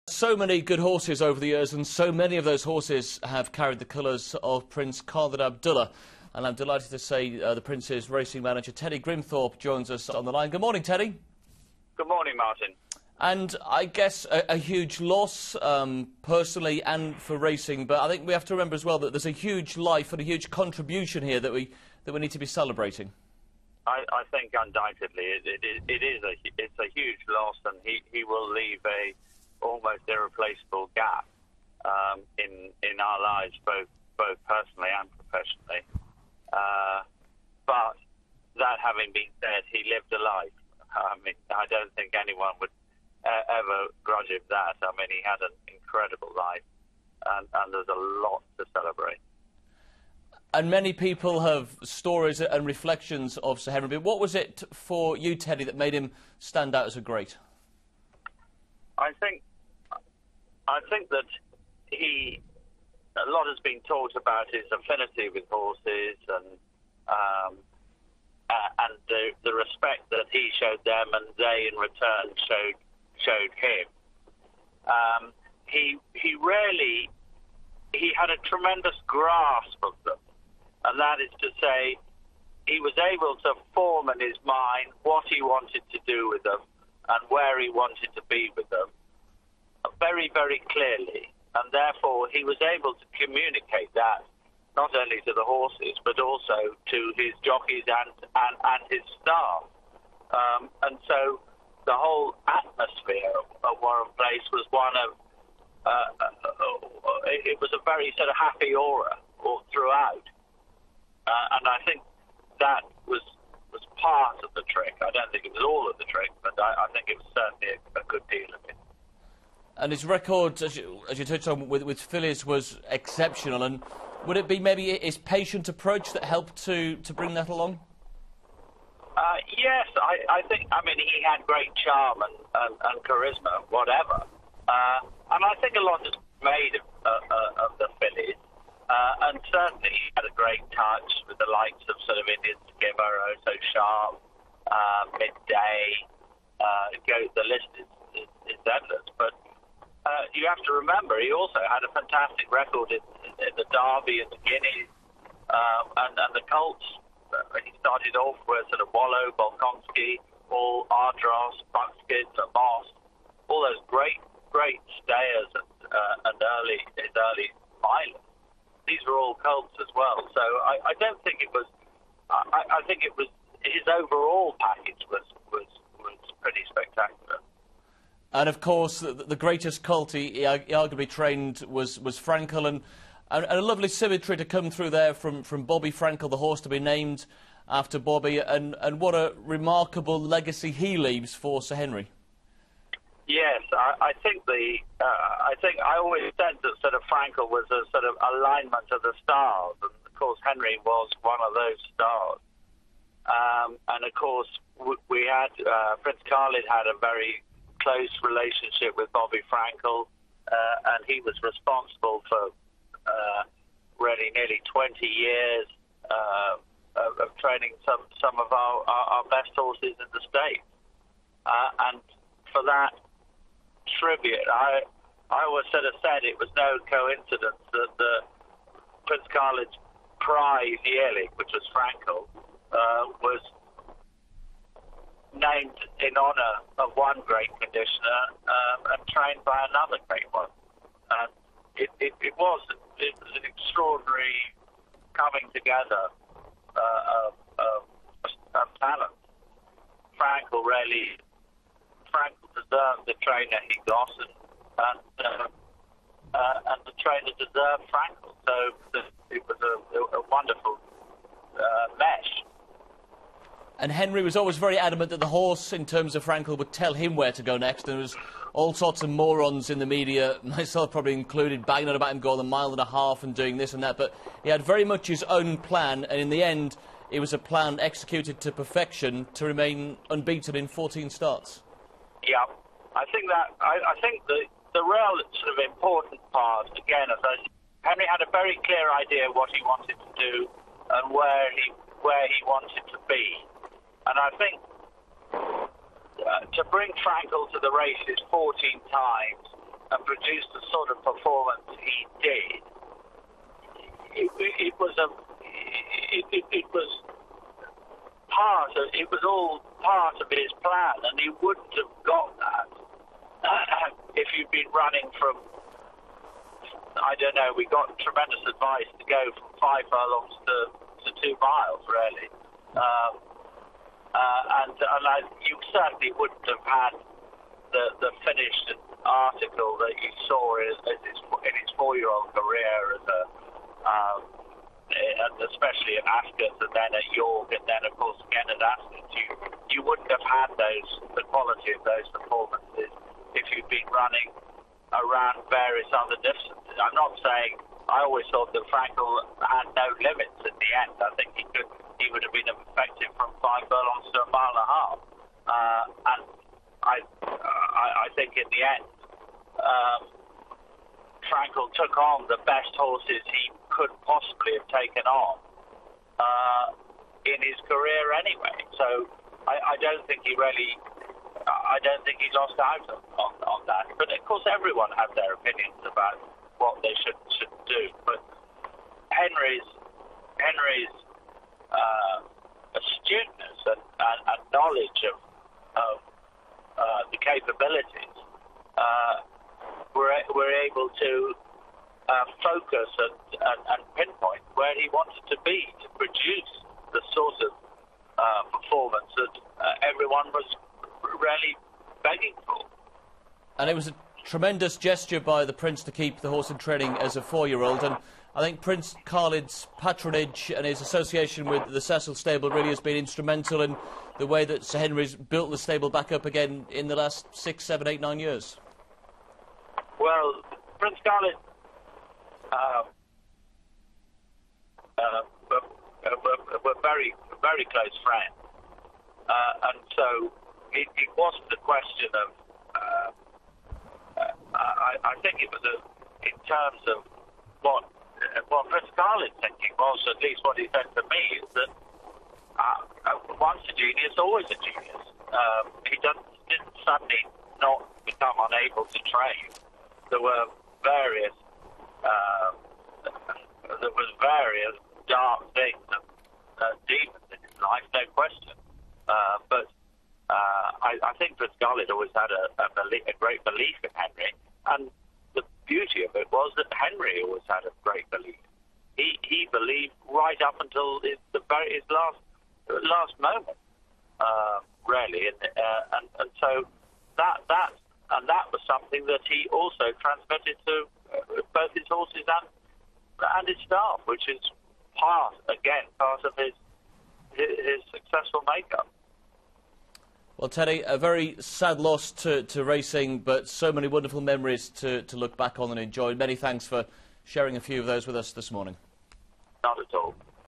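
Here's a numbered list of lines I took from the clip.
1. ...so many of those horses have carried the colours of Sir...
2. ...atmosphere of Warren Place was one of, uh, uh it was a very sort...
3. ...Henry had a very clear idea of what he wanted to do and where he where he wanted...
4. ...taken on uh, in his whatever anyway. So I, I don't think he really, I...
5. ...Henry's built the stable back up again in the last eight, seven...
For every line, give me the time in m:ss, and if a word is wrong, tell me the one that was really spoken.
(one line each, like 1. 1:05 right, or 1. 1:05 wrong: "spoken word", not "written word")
1. 0:01 wrong: "Prince", not "Sir"
2. 1:42 right
3. 4:47 right
4. 6:04 wrong: "career", not "whatever"
5. 6:54 wrong: "six", not "eight".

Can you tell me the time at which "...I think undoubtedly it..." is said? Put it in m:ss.
0:24.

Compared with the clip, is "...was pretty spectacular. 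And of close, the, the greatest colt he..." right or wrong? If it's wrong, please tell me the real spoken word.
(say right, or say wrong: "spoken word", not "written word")
wrong: "course", not "close".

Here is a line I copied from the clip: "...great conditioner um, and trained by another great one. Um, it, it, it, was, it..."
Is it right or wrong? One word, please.
right.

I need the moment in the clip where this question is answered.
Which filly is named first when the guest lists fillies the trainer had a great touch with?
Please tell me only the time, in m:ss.
2:22.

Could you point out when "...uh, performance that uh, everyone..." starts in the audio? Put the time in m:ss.
6:38.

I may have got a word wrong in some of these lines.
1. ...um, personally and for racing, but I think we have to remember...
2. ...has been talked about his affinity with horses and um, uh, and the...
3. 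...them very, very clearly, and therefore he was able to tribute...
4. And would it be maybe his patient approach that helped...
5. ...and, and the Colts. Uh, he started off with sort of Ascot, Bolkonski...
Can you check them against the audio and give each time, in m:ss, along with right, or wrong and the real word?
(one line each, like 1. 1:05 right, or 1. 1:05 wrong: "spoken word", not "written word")
1. 0:15 right
2. 1:03 right
3. 1:28 wrong: "communicate", not "tribute"
4. 2:03 right
5. 2:36 wrong: "Wollow", not "Ascot".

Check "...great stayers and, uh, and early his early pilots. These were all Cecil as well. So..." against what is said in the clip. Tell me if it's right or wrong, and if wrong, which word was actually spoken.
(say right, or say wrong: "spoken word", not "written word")
wrong: "Colts", not "Cecil".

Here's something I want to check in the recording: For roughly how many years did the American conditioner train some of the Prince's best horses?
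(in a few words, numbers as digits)
20 years.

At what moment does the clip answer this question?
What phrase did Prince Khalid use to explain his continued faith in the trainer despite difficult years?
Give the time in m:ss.
7:23.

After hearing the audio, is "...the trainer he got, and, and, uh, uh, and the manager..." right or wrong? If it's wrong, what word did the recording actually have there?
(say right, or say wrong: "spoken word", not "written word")
wrong: "trainer", not "manager".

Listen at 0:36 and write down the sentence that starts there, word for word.
Uh, but that having been said, he lived a life.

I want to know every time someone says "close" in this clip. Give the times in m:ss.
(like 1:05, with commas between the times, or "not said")
3:27, 7:07.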